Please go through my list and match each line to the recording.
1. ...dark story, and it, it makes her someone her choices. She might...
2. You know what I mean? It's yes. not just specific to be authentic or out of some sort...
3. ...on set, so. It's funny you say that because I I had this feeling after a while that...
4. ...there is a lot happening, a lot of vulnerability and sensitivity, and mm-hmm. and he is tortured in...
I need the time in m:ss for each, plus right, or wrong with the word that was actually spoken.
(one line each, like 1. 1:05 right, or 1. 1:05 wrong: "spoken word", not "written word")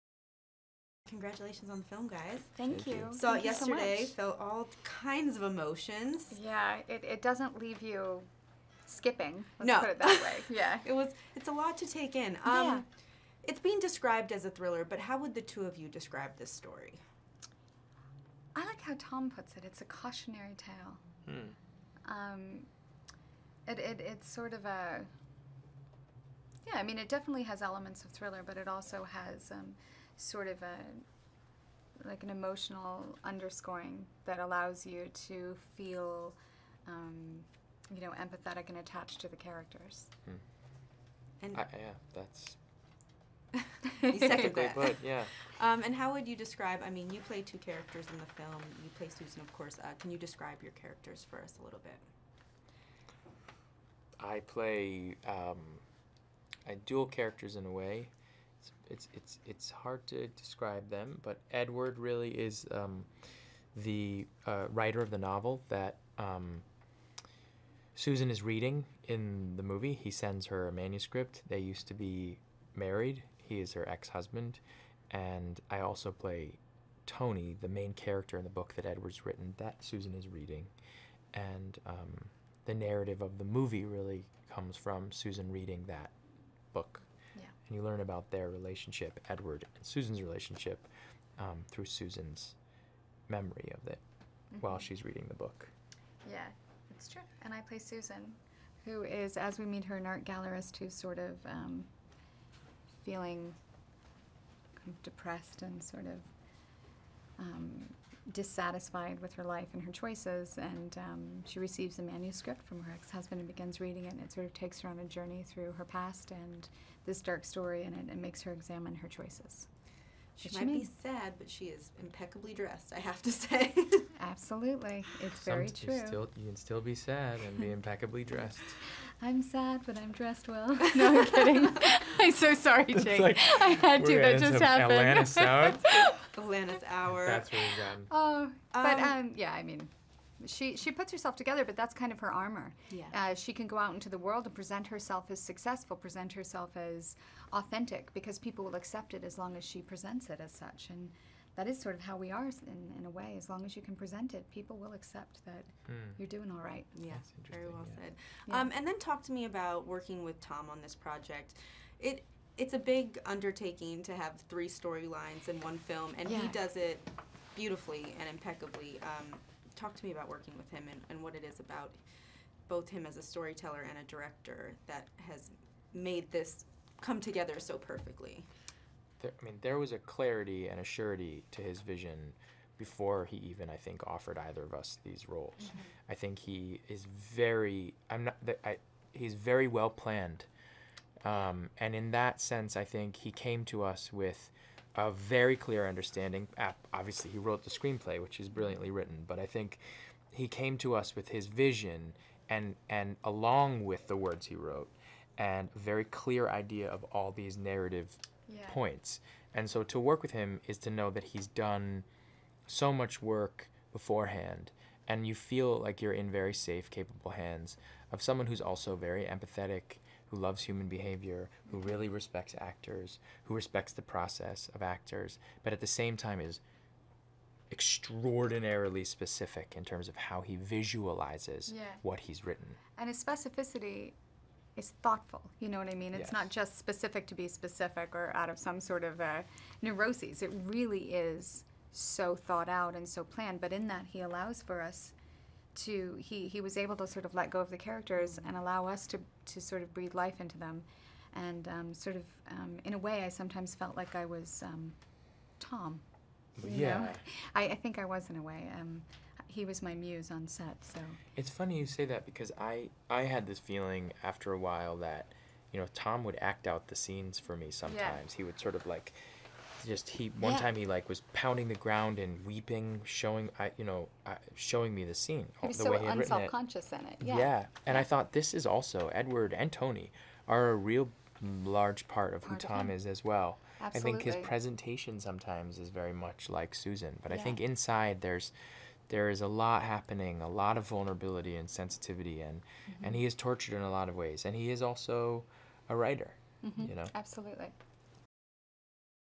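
1. 1:57 wrong: "examine", not "someone"
2. 3:55 wrong: "specific", not "authentic"
3. 4:20 right
4. 4:49 right.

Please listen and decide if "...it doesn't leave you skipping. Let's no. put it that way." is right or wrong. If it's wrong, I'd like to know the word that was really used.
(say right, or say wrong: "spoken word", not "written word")
right.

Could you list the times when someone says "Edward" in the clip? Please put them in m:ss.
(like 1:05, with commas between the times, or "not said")
1:01, 1:18, 1:29, 4:39.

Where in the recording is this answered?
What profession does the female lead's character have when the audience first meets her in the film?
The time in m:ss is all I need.
1:39.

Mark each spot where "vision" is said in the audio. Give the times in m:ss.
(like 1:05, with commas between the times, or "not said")
3:01, 3:21.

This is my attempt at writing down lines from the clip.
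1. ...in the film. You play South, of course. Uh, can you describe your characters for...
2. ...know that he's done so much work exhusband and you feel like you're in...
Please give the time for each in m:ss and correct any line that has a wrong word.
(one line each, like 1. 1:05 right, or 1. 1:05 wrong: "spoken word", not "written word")
1. 0:48 wrong: "Susan", not "South"
2. 3:30 wrong: "beforehand", not "exhusband".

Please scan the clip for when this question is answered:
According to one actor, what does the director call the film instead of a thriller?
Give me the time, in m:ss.
0:19.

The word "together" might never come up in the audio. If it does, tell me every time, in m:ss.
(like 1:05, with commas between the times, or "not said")
2:21, 2:57.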